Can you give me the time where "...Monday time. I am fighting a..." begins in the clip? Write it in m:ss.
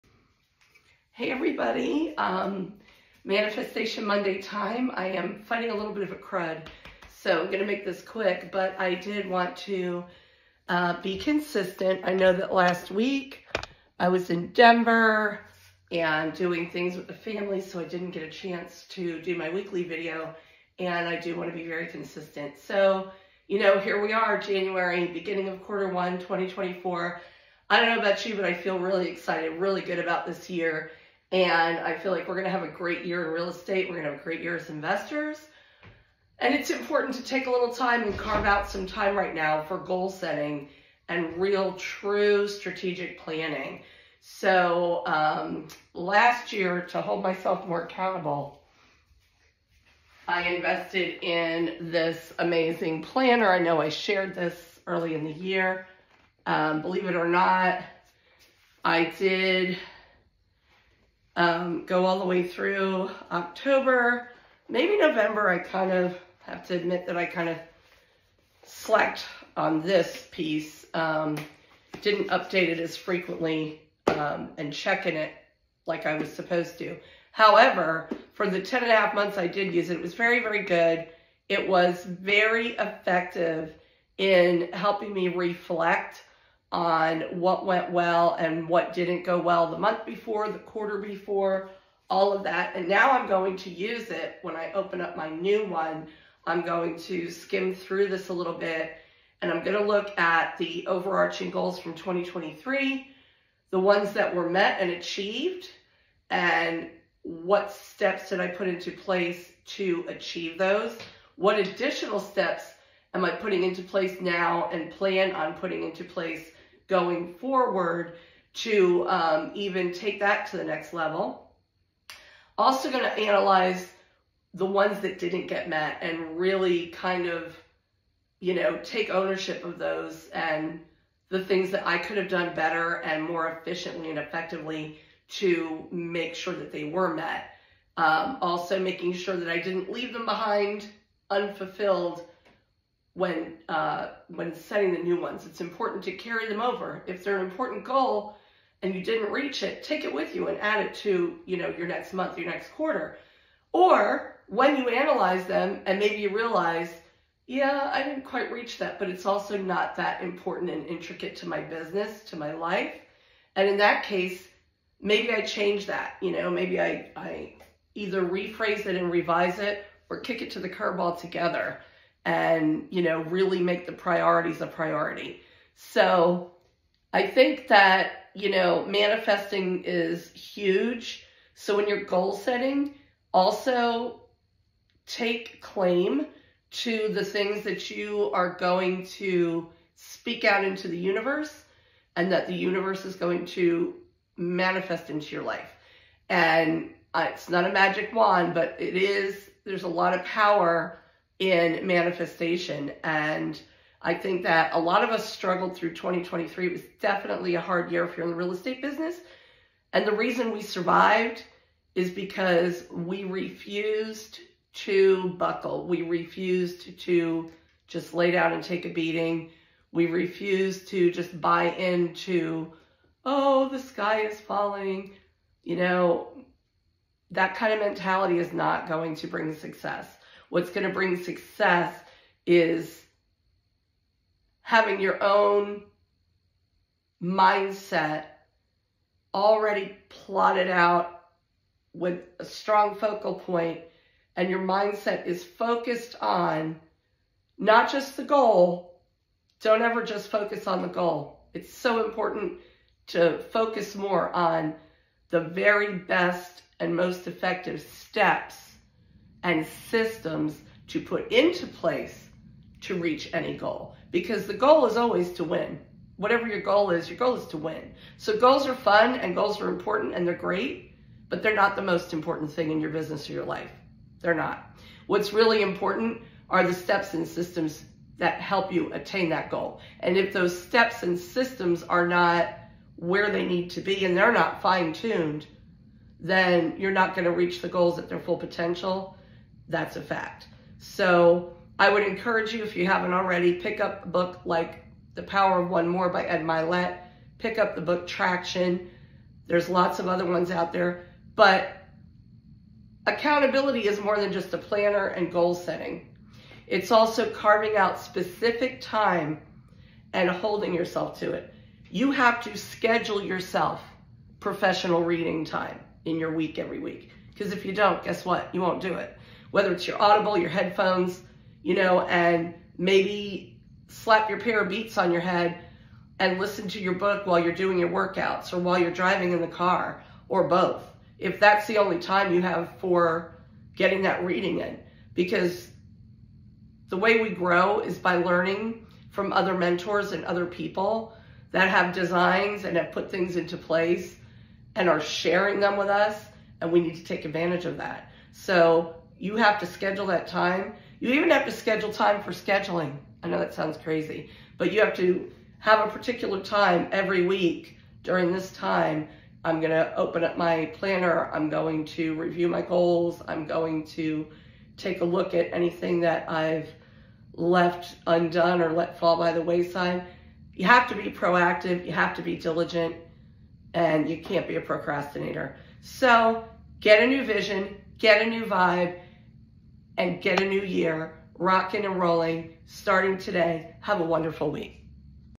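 0:04.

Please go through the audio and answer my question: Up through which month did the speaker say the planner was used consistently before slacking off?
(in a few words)
October.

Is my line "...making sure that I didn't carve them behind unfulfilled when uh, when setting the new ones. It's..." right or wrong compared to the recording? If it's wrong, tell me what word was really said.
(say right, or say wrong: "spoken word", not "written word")
wrong: "leave", not "carve".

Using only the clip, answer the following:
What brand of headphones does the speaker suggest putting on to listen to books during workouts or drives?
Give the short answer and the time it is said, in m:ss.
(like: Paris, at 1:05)
Beats, at 5:24.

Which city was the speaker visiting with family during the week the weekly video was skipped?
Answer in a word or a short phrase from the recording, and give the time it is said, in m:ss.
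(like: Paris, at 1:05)
Denver, at 0:14.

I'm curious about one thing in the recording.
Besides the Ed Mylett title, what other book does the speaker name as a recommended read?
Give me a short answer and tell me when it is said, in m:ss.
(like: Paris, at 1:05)
Traction, at 4:58.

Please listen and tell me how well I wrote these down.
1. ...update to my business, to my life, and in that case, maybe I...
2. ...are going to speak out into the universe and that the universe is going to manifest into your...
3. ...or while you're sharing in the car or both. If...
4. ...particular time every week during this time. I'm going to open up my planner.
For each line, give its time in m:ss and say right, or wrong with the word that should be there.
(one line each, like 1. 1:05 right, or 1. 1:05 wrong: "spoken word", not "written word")
1. 2:40 wrong: "intricate", not "update"
2. 3:08 right
3. 5:28 wrong: "driving", not "sharing"
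4. 5:55 right.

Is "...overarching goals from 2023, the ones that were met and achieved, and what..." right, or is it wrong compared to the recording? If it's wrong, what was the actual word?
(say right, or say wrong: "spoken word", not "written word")
right.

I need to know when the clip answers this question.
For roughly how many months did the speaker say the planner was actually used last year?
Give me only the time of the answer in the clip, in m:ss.
1:18.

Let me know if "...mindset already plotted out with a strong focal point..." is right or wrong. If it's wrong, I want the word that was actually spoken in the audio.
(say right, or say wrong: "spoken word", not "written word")
right.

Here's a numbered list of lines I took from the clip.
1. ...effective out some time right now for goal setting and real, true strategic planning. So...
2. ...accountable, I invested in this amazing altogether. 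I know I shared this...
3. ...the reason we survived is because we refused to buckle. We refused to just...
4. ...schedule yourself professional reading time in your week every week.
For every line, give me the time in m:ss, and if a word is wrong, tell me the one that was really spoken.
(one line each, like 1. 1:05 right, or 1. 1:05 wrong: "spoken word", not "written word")
1. 0:38 wrong: "carve", not "effective"
2. 0:47 wrong: "planner", not "altogether"
3. 3:30 right
4. 5:12 right.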